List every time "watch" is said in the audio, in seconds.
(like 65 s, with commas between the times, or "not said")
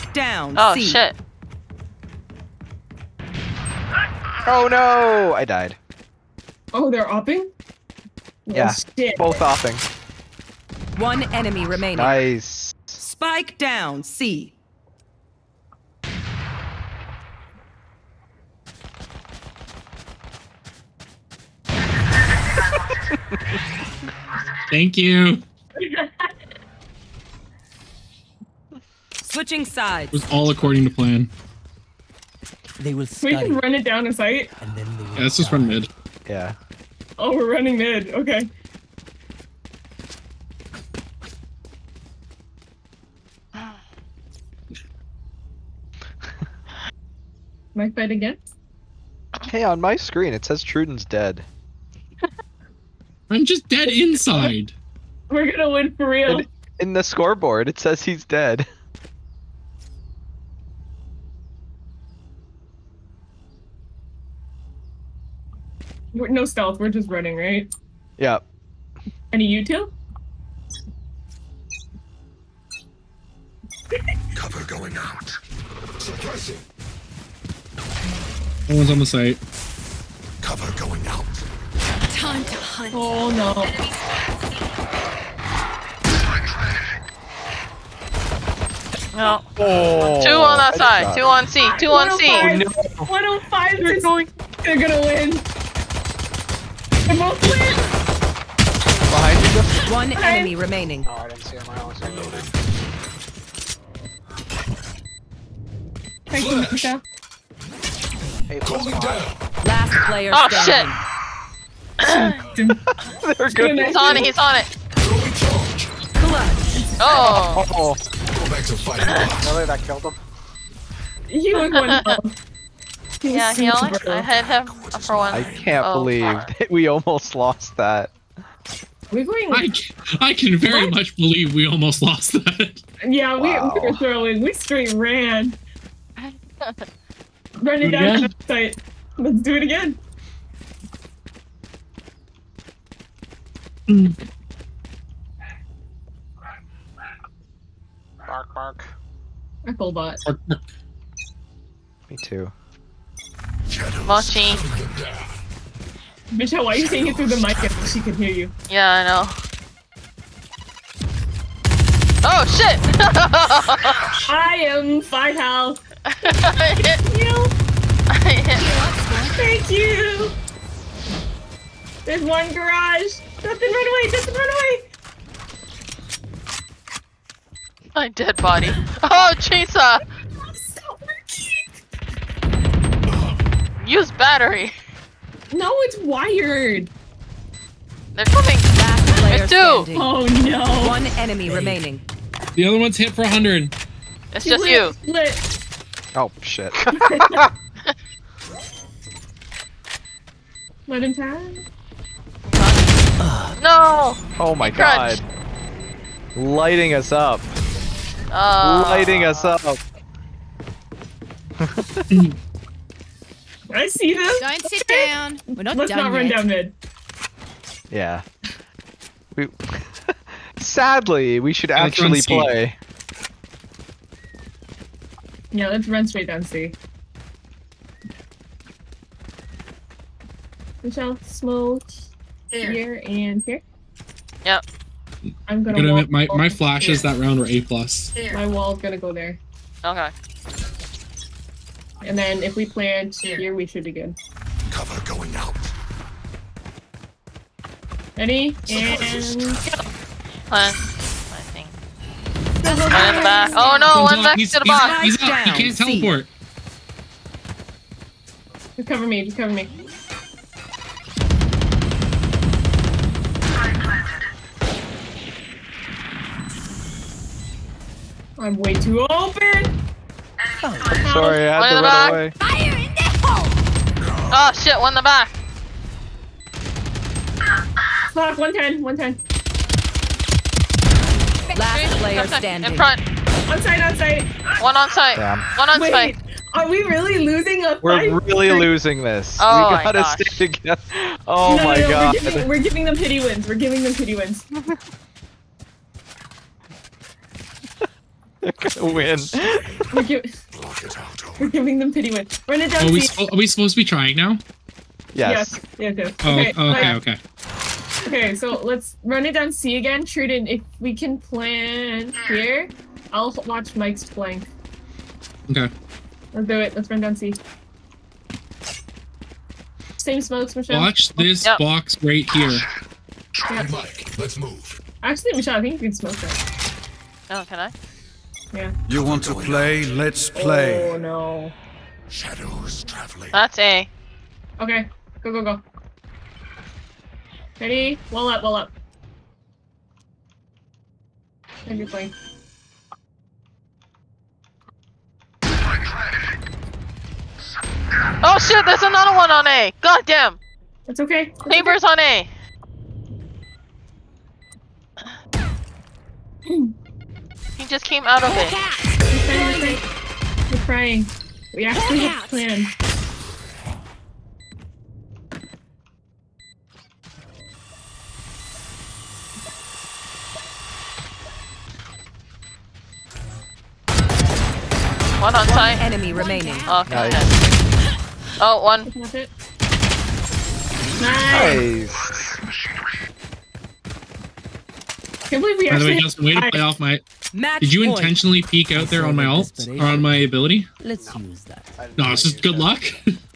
313 s, 320 s.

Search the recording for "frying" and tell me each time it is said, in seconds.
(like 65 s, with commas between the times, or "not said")
361 s.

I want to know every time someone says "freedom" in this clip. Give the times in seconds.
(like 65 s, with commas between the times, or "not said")
not said.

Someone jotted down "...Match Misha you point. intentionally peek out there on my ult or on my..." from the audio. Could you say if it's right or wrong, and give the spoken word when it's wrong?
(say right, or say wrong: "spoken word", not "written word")
wrong: "Did", not "Misha".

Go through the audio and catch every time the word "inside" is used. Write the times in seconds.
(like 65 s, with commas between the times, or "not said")
53 s.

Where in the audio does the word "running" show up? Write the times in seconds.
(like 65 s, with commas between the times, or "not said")
37 s, 67 s, 137 s.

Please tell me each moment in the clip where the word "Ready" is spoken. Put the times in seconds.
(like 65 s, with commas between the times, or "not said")
248 s, 337 s.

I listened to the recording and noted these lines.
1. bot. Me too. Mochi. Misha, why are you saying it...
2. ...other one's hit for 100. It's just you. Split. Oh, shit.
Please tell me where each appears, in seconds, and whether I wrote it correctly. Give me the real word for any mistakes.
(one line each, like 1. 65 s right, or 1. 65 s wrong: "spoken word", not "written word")
1. 149 s right
2. 192 s right.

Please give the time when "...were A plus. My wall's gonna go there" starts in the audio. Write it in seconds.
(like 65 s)
237 s.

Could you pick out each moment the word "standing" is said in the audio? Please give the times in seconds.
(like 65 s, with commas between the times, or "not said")
110 s, 189 s, 282 s.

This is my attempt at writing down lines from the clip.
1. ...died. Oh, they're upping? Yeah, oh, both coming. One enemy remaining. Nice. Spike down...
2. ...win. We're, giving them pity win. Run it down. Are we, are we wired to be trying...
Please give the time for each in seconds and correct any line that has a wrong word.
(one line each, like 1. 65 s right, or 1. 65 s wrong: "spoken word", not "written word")
1. 5 s wrong: "upping", not "coming"
2. 298 s wrong: "supposed", not "wired".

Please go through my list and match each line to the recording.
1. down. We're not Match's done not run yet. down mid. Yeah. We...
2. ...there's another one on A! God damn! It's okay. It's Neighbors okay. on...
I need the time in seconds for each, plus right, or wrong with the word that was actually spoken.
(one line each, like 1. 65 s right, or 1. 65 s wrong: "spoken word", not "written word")
1. 215 s wrong: "Let", not "Match"
2. 348 s right.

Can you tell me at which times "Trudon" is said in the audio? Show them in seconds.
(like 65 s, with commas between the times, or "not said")
50 s, 310 s.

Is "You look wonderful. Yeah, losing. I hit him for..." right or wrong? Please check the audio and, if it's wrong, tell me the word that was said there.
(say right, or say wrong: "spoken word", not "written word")
wrong: "healing", not "losing".